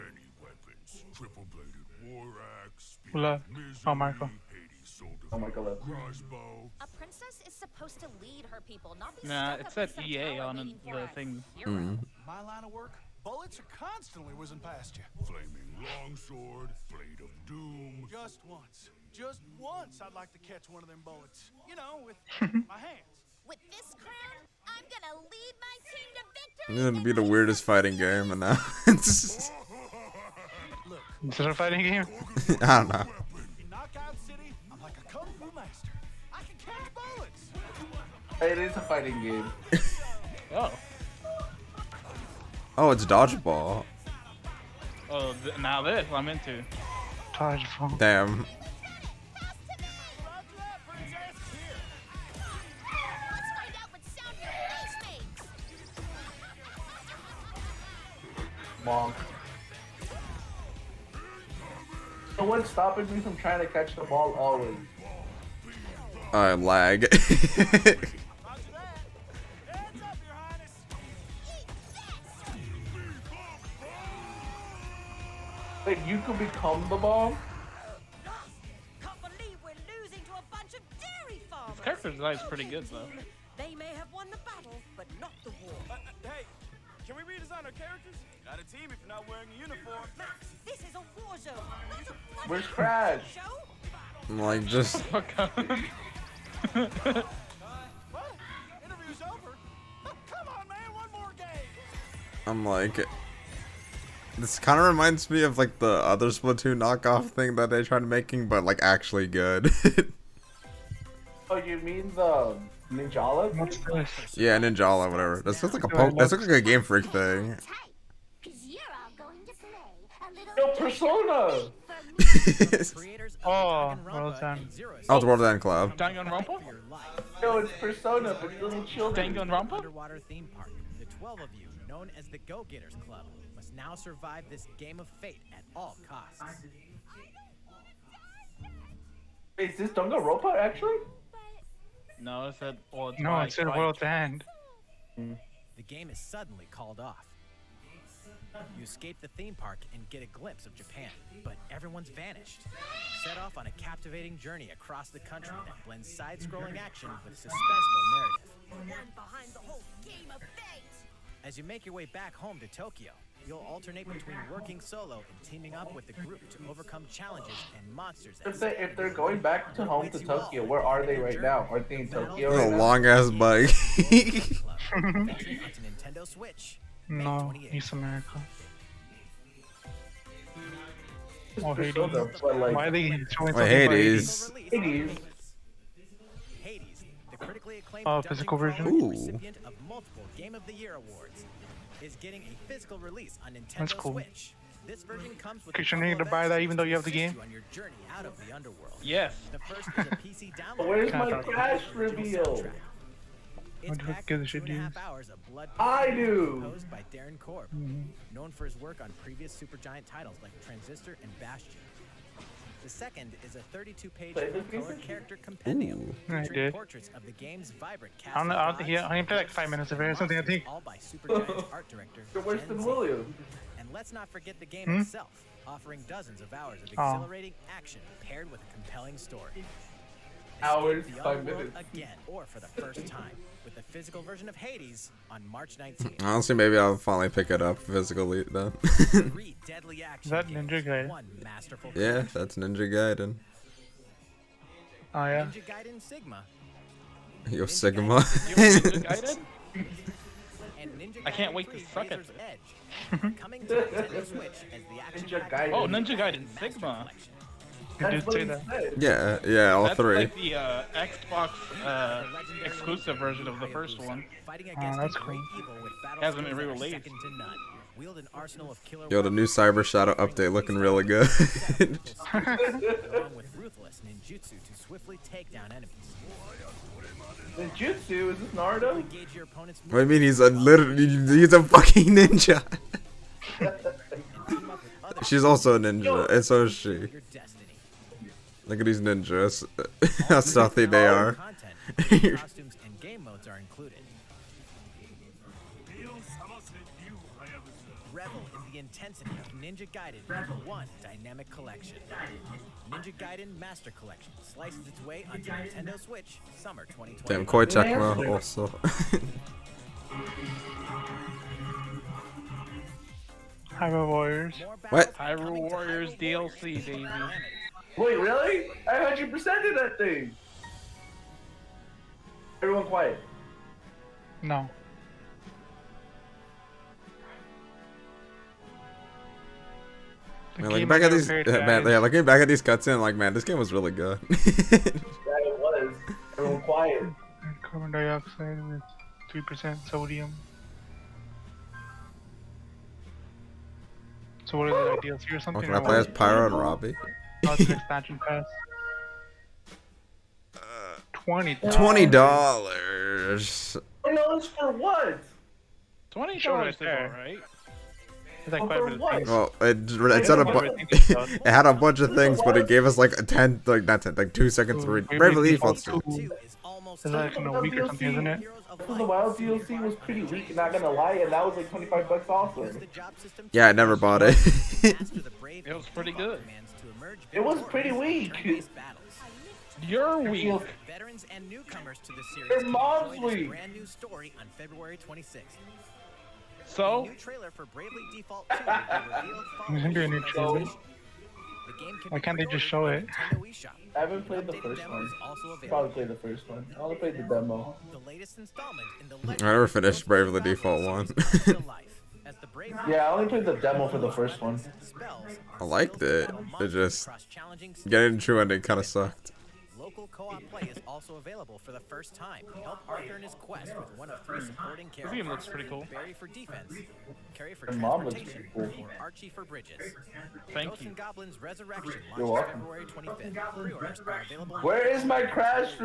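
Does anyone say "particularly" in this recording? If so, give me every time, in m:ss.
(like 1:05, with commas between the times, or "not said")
not said.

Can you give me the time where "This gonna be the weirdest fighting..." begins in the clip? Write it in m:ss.
0:26.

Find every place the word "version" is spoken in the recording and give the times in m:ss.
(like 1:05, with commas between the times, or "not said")
3:08, 3:15, 3:54, 4:23.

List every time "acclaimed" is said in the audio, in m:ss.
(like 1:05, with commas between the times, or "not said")
3:07.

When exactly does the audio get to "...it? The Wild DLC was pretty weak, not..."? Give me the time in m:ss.
6:08.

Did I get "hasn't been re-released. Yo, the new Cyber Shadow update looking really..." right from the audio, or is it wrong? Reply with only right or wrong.
right.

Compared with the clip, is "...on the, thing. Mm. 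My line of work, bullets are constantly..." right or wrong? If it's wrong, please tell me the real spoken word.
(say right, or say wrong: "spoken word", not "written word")
right.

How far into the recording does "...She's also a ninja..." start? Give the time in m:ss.
4:45.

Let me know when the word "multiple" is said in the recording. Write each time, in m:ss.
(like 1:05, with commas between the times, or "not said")
3:09.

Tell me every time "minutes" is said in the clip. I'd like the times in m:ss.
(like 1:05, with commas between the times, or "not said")
3:39, 3:51.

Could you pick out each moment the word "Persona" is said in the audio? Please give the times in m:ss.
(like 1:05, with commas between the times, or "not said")
2:00, 2:07.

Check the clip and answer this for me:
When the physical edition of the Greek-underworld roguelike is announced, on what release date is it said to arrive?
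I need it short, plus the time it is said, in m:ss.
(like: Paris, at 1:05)
March 19th, at 3:55.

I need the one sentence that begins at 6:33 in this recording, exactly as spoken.
I haven't played the first one.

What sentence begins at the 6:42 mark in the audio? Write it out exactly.
Yeah, I only played the demo for the first one.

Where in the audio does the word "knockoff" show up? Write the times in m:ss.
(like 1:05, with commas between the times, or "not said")
1:46.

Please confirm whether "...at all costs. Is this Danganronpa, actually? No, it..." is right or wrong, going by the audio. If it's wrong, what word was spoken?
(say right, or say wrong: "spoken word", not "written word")
right.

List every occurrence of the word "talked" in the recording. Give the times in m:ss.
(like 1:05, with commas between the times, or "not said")
not said.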